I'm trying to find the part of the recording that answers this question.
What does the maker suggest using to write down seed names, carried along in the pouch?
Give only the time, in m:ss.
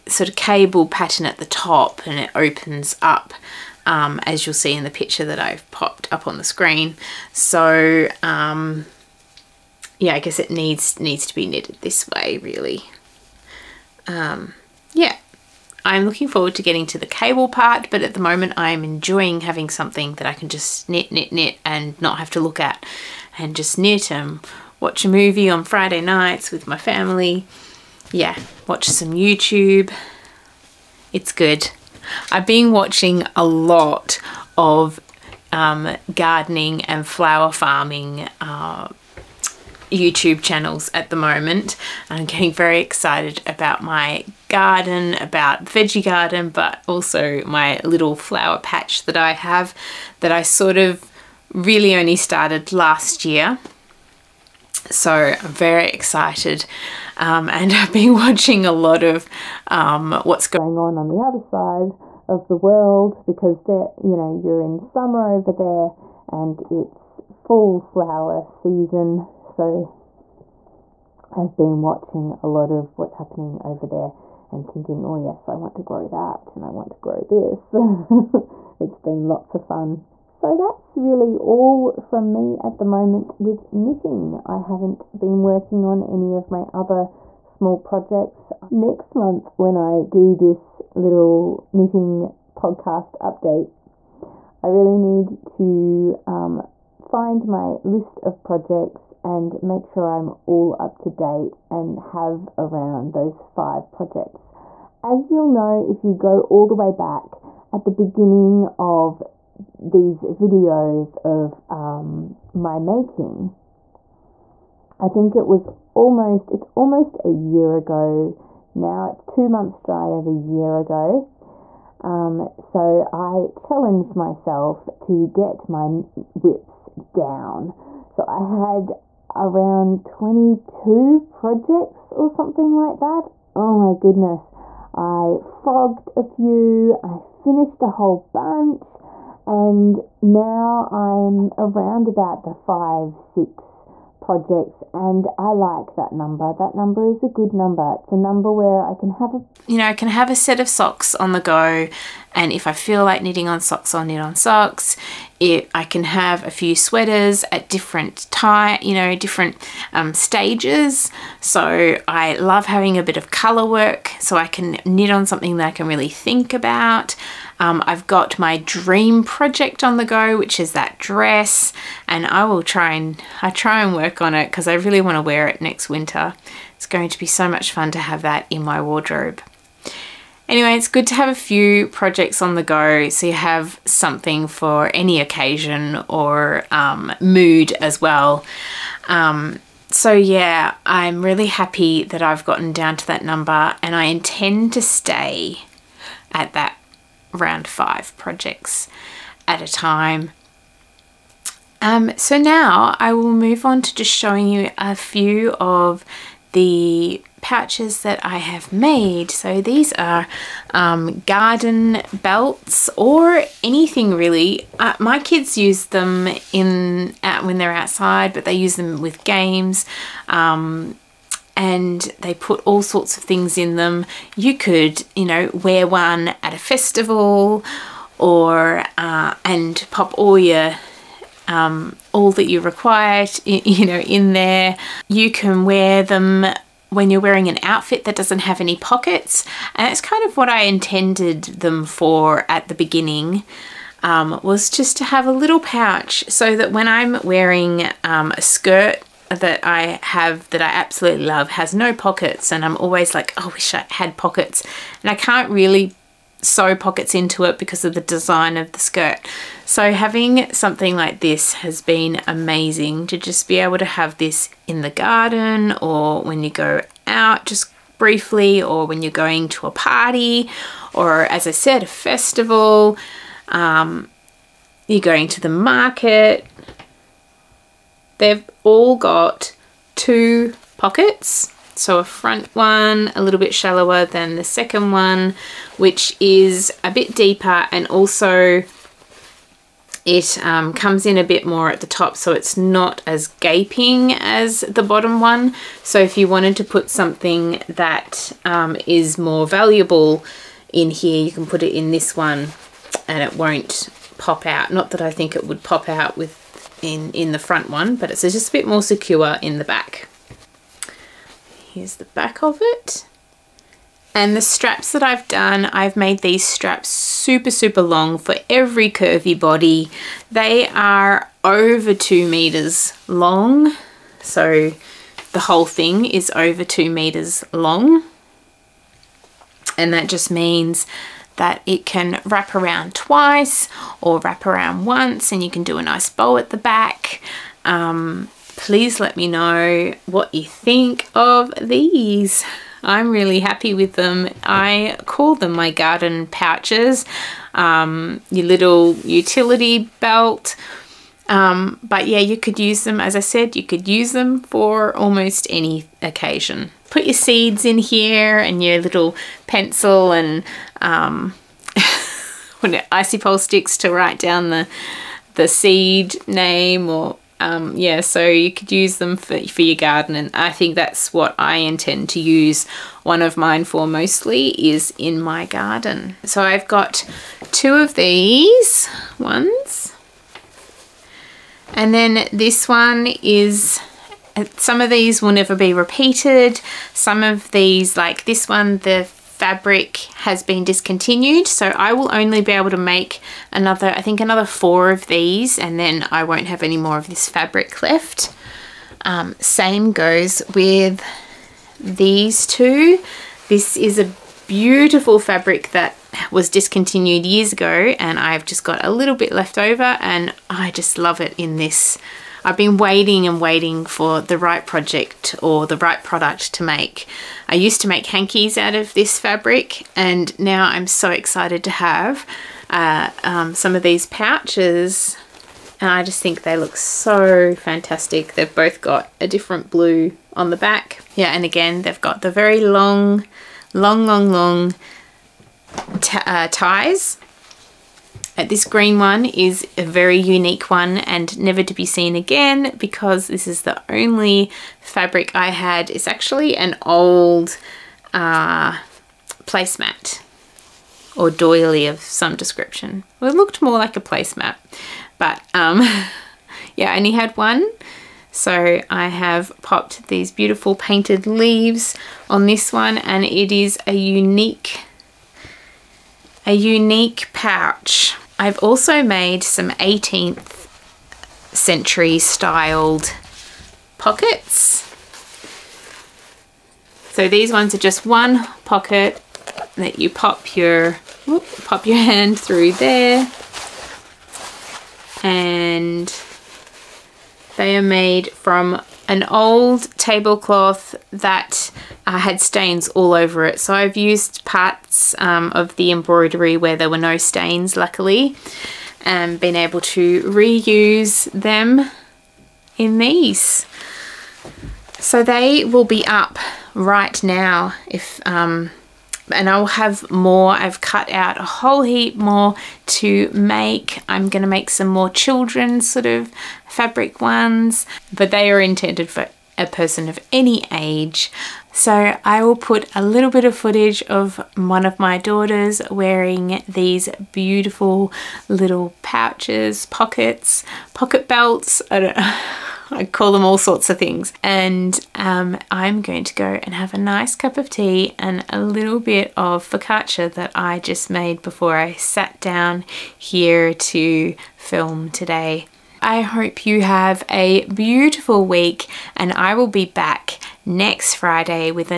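6:02.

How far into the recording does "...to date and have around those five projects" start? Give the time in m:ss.
1:40.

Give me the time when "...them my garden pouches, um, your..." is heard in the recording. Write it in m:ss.
5:45.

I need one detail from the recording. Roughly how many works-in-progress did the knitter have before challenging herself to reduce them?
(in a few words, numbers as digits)
22.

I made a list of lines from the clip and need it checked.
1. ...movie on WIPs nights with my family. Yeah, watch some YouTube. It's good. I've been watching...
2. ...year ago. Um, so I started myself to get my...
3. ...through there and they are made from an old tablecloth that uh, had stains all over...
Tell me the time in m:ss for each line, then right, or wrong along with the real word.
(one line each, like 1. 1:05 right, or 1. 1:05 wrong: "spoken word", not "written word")
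1. 0:25 wrong: "Friday", not "WIPs"
2. 2:00 wrong: "challenged", not "started"
3. 8:02 right.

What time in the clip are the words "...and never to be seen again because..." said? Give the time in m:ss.
7:20.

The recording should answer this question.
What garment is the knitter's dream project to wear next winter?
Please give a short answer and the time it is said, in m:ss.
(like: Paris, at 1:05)
Dress, at 2:50.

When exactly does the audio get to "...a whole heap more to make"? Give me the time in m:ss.
8:31.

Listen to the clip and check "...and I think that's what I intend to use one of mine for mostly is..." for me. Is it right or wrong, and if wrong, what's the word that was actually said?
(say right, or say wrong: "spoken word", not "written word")
right.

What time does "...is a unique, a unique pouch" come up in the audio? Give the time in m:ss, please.
7:43.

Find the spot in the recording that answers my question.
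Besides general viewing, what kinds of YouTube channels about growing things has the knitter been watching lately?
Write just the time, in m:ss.
0:36.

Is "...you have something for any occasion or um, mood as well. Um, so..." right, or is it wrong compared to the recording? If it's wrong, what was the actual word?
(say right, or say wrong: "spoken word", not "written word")
right.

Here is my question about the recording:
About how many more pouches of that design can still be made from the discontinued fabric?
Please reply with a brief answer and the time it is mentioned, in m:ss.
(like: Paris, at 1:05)
4, at 6:34.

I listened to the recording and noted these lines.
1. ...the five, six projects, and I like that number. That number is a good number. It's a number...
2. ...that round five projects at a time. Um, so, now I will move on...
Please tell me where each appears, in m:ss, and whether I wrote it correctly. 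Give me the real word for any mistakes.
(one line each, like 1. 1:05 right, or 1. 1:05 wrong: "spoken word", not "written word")
1. 2:22 right
2. 3:16 right.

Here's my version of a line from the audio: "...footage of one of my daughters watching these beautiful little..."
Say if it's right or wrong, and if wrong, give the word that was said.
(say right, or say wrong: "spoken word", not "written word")
wrong: "wearing", not "watching".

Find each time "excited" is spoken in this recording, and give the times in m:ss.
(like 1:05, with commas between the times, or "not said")
0:42, 0:55, 7:01.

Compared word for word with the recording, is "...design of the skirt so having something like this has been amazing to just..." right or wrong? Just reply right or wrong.
right.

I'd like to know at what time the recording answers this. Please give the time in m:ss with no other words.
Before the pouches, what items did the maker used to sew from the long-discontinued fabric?
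6:58.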